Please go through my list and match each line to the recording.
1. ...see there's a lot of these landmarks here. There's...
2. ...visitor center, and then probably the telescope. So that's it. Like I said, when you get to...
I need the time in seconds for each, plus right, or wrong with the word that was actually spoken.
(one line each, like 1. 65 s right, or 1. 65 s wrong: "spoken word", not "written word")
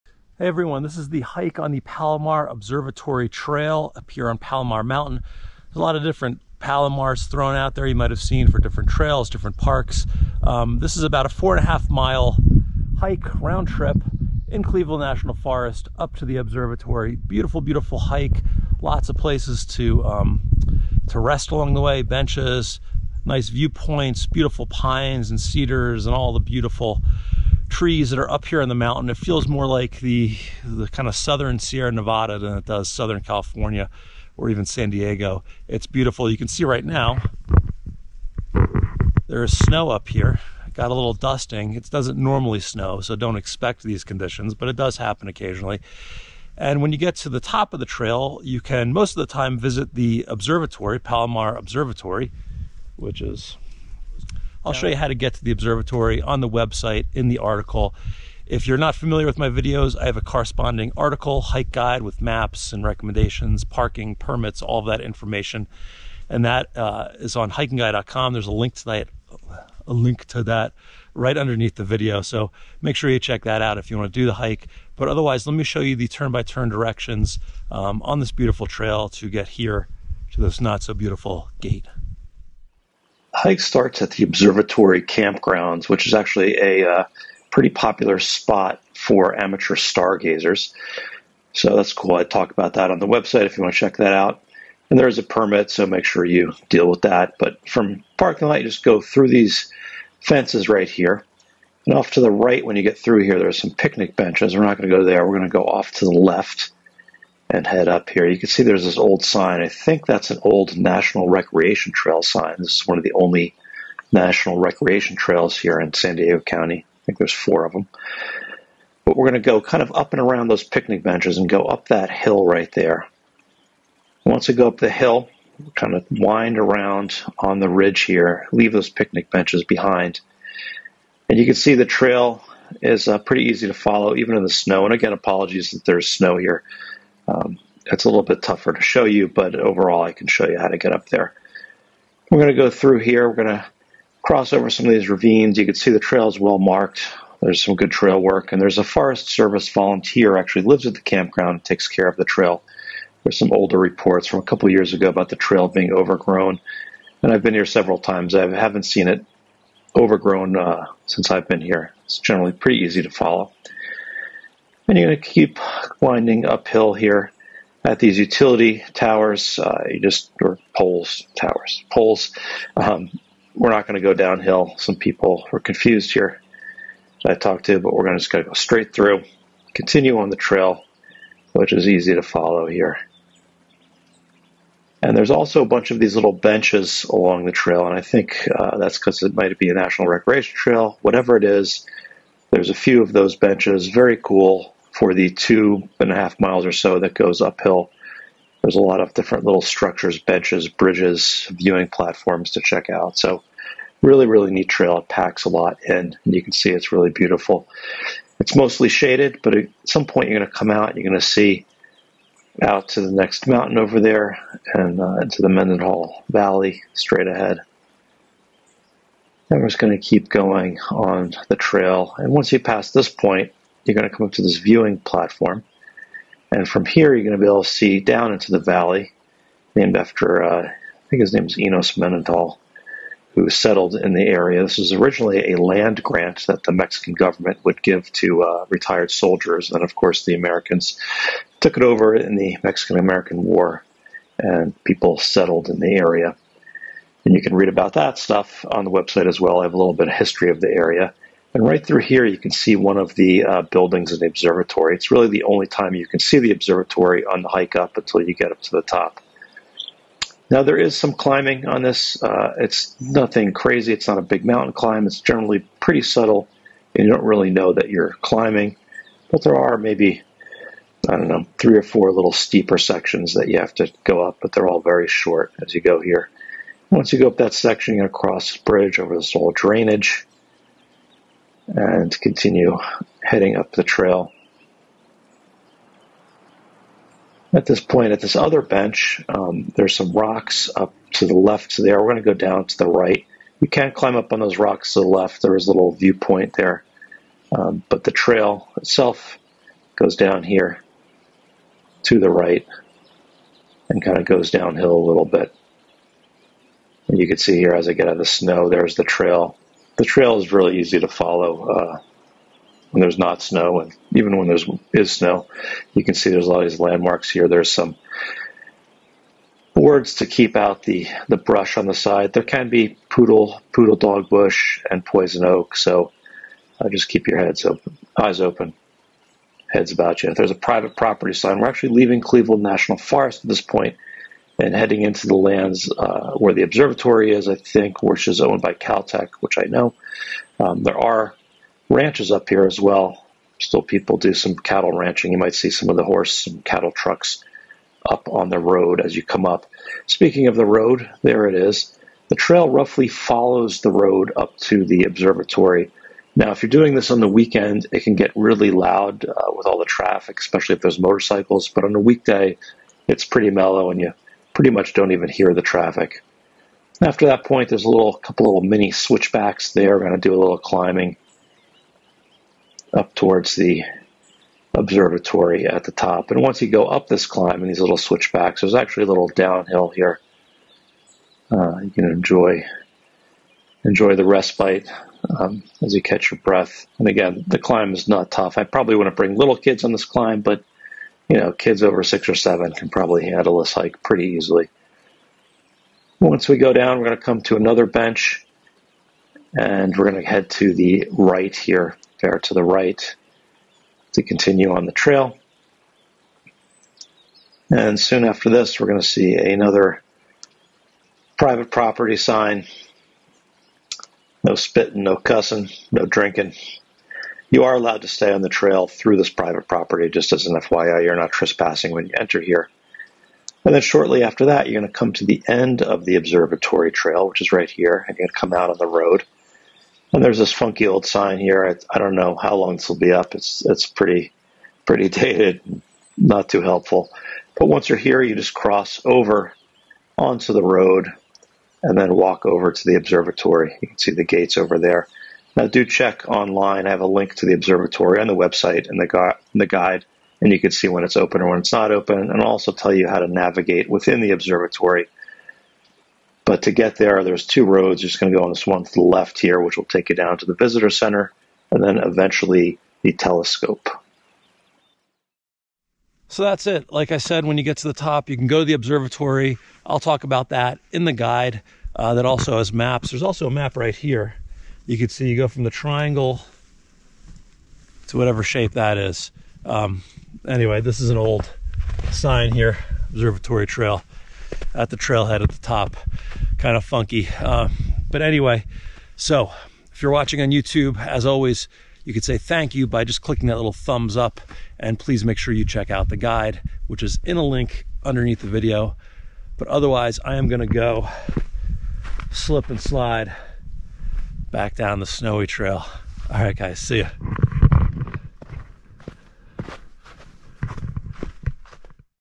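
1. 316 s right
2. 460 s wrong: "eventually", not "probably".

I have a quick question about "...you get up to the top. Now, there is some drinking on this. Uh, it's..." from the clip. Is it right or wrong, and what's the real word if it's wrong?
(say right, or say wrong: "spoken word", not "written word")
wrong: "climbing", not "drinking".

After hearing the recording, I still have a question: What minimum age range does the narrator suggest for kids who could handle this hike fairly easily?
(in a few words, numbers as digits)
6 or 7.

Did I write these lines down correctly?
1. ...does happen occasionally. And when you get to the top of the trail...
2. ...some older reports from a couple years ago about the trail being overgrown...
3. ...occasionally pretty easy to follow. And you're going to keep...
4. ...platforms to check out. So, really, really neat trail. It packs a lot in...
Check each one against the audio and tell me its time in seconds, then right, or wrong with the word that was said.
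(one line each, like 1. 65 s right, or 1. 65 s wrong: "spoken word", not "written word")
1. 44 s right
2. 153 s right
3. 162 s wrong: "generally", not "occasionally"
4. 201 s right.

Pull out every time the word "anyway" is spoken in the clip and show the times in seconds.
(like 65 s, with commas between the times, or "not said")
480 s, 488 s.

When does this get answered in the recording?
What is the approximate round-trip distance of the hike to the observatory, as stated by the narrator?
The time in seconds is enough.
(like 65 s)
11 s.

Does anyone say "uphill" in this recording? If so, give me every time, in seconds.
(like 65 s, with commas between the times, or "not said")
166 s, 197 s.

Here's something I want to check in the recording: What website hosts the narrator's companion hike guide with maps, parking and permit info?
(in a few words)
hikingguy.com.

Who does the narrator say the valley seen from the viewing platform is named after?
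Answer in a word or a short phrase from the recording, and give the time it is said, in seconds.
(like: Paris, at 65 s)
Enos Mendenhall, at 231 s.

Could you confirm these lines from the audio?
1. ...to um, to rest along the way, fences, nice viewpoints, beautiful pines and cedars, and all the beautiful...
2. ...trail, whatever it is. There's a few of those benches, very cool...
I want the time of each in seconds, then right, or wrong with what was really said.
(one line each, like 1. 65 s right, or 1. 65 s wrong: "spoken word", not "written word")
1. 19 s wrong: "benches", not "fences"
2. 190 s right.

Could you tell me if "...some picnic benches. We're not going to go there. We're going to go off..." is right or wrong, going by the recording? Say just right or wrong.
right.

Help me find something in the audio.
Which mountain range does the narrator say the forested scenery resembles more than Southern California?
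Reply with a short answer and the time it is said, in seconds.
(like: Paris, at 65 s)
Southern Sierra Nevada, at 31 s.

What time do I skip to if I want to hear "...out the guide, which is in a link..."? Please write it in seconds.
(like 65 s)
495 s.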